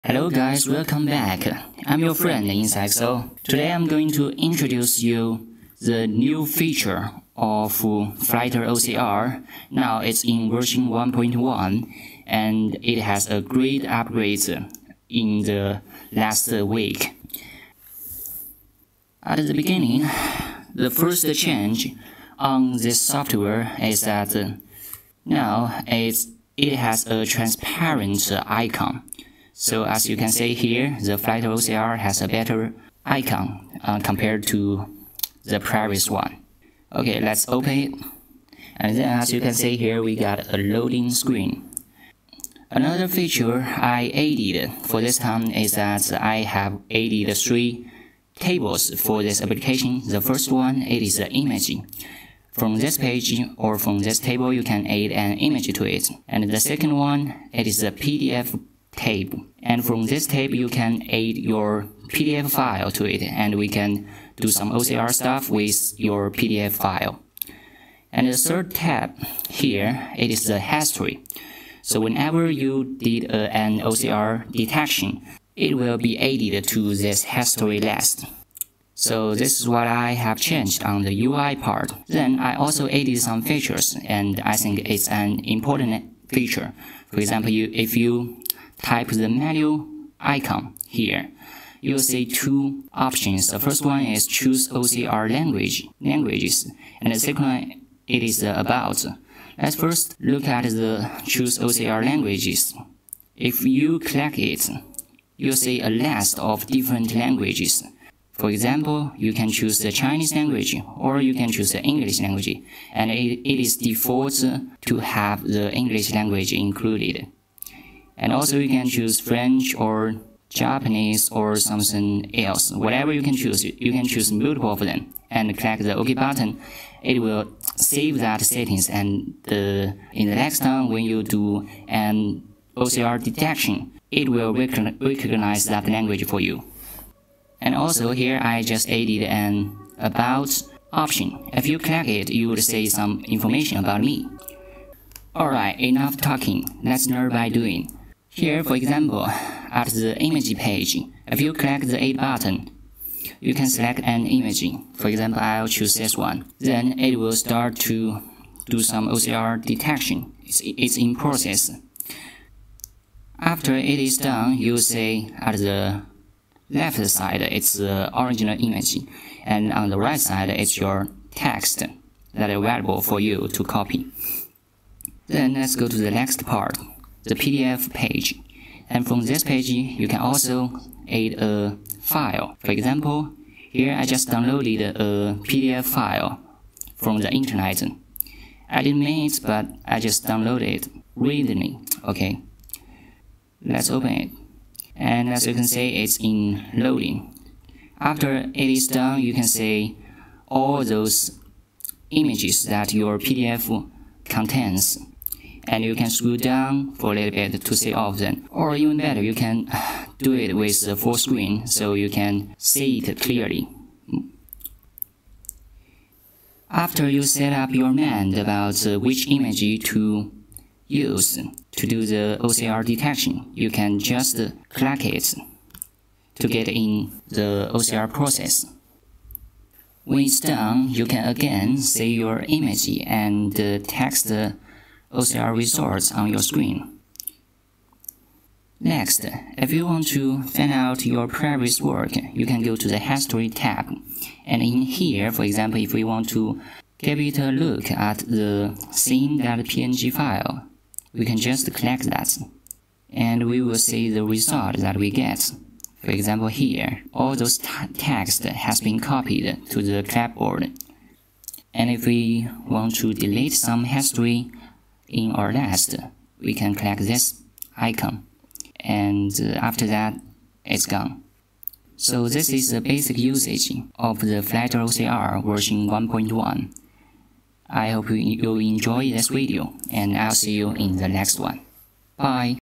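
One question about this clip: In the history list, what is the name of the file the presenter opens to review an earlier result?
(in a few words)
scene.png.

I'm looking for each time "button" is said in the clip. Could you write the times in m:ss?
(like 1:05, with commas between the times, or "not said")
2:06, 2:32.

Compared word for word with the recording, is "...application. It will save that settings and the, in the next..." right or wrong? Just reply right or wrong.
wrong.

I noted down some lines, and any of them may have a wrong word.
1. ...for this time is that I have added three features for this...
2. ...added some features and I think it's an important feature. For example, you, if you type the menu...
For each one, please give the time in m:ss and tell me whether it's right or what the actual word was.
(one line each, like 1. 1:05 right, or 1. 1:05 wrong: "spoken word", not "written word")
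1. 0:44 wrong: "tables", not "features"
2. 1:22 right.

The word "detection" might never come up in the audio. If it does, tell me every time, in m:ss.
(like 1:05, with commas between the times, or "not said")
1:14, 2:13, 2:39, 3:42.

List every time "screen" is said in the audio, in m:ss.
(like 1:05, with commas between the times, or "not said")
0:41, 3:31, 3:56.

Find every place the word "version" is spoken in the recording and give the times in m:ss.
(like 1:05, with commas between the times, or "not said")
0:10, 4:35.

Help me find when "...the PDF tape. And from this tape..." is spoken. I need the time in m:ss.
0:57.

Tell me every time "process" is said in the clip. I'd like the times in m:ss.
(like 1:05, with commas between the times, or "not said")
2:41, 3:48.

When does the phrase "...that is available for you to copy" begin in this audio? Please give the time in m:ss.
2:52.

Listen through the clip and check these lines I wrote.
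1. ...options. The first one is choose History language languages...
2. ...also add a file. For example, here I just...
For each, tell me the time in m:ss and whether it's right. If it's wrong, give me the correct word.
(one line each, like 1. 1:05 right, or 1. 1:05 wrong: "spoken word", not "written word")
1. 1:32 wrong: "OCR", not "History"
2. 3:00 right.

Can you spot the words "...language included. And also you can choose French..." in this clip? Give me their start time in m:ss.
1:56.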